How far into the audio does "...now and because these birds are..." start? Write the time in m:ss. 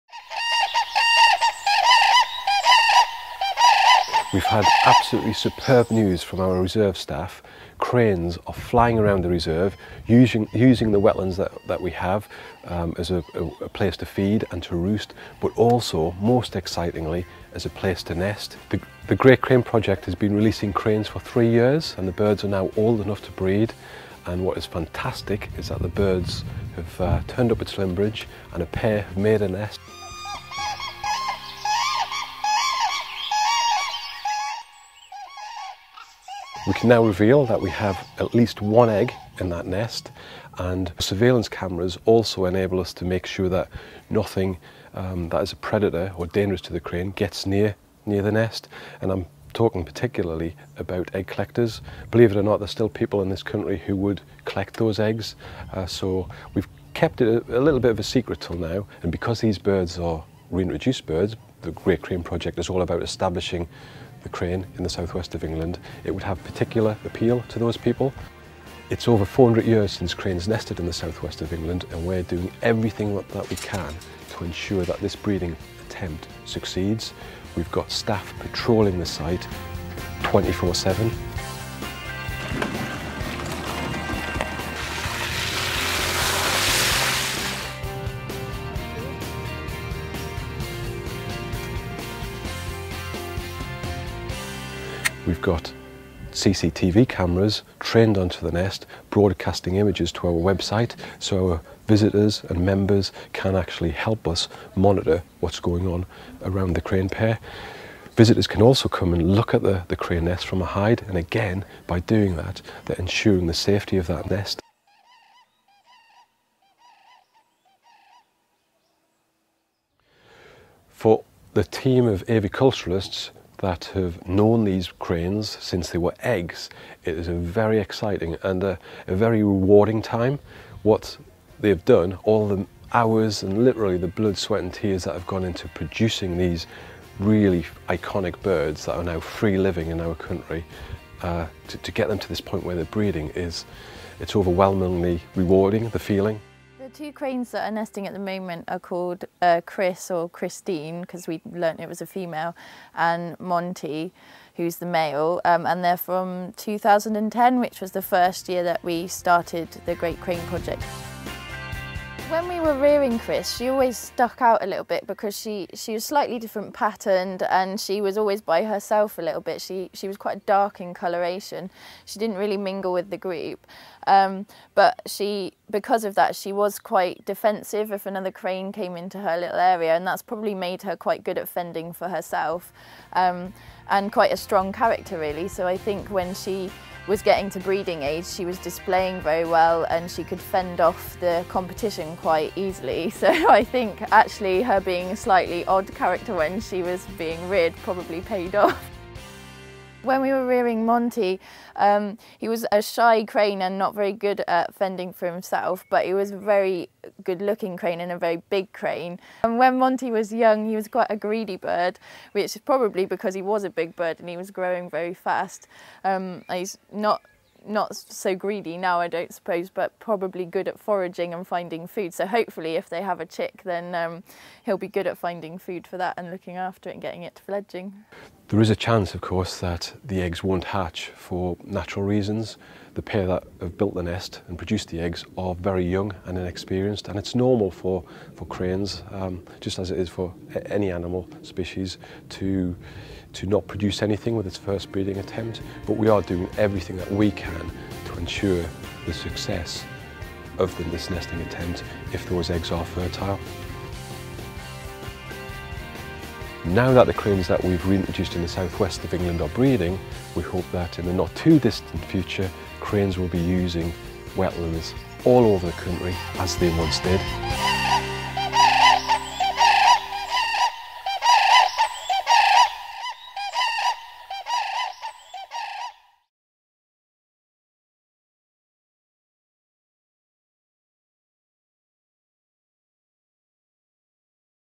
0:58.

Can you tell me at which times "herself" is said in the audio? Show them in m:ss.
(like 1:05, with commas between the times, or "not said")
2:48, 3:02.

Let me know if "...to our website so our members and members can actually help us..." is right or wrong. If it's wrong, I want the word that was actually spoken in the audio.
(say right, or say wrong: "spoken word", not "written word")
wrong: "visitors", not "members".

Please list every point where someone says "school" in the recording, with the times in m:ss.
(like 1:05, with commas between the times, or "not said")
not said.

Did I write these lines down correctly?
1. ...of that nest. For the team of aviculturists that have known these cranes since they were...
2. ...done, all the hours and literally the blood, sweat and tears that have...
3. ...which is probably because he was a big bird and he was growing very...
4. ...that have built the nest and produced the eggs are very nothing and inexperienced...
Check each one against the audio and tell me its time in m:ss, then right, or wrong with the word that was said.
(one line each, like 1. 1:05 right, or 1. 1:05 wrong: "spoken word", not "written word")
1. 1:53 right
2. 2:11 right
3. 3:32 right
4. 3:53 wrong: "young", not "nothing".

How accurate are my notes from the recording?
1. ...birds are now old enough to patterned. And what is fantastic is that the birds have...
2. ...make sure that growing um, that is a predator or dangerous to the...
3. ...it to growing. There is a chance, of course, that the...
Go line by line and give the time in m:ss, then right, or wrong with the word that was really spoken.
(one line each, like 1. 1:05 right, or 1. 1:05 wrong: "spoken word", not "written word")
1. 0:22 wrong: "breed", not "patterned"
2. 0:43 wrong: "nothing", not "growing"
3. 3:47 wrong: "fledging", not "growing".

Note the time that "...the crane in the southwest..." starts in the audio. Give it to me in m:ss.
1:04.